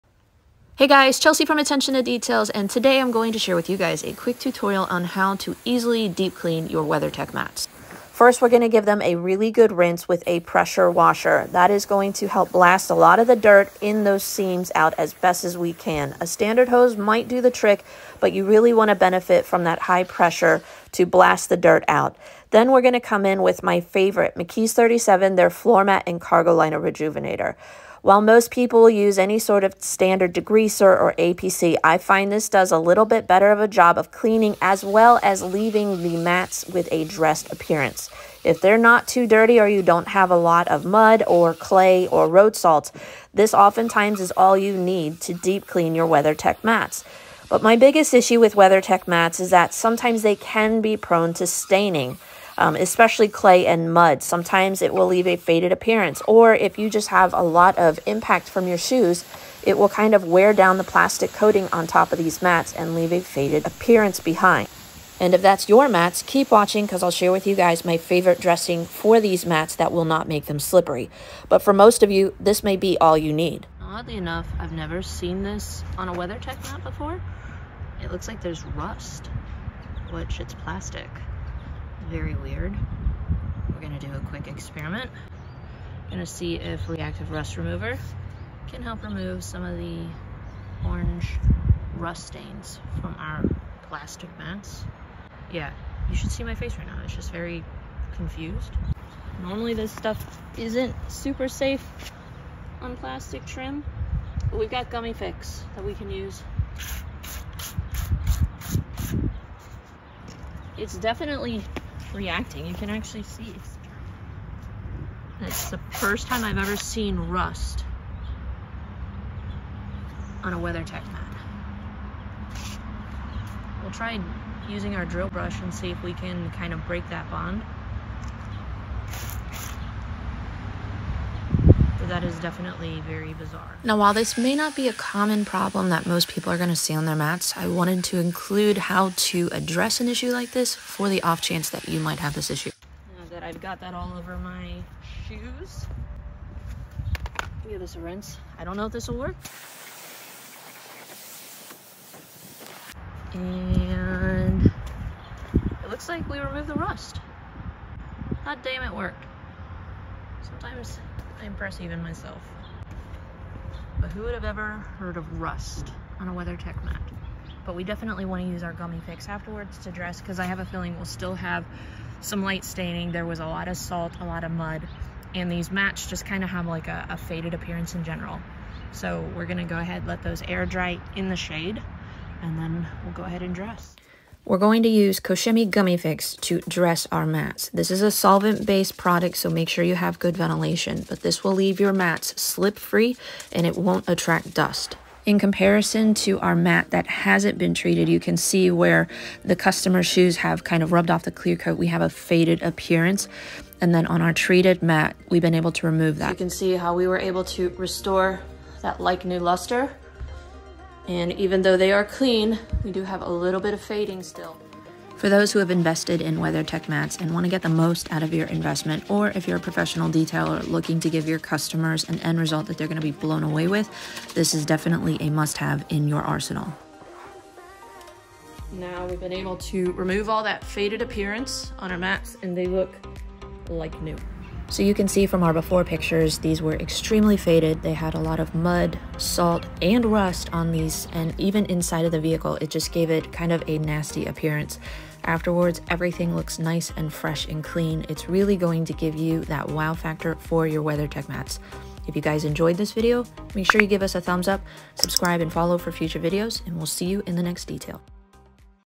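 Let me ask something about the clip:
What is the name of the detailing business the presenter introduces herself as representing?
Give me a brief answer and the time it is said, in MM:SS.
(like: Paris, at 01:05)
Attention to Details, at 00:01.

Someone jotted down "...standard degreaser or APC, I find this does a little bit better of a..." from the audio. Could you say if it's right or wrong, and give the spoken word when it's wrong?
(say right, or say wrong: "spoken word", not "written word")
right.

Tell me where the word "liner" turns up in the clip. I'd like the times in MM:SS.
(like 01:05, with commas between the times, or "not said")
00:26.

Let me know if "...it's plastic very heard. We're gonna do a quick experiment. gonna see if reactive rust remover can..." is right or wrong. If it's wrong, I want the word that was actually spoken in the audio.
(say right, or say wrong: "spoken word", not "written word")
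wrong: "weird", not "heard".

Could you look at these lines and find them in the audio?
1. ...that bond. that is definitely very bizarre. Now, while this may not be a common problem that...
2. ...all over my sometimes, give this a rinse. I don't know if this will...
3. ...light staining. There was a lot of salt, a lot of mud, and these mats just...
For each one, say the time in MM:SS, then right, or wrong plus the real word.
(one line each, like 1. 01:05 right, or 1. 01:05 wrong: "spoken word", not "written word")
1. 02:07 right
2. 02:23 wrong: "shoes", not "sometimes"
3. 02:52 right.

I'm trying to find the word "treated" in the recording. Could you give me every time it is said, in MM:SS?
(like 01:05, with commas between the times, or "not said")
03:17, 03:24.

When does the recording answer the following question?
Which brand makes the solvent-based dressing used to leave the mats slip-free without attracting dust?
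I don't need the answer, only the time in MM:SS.
03:05.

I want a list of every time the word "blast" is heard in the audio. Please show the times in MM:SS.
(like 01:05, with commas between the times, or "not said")
00:12, 00:21.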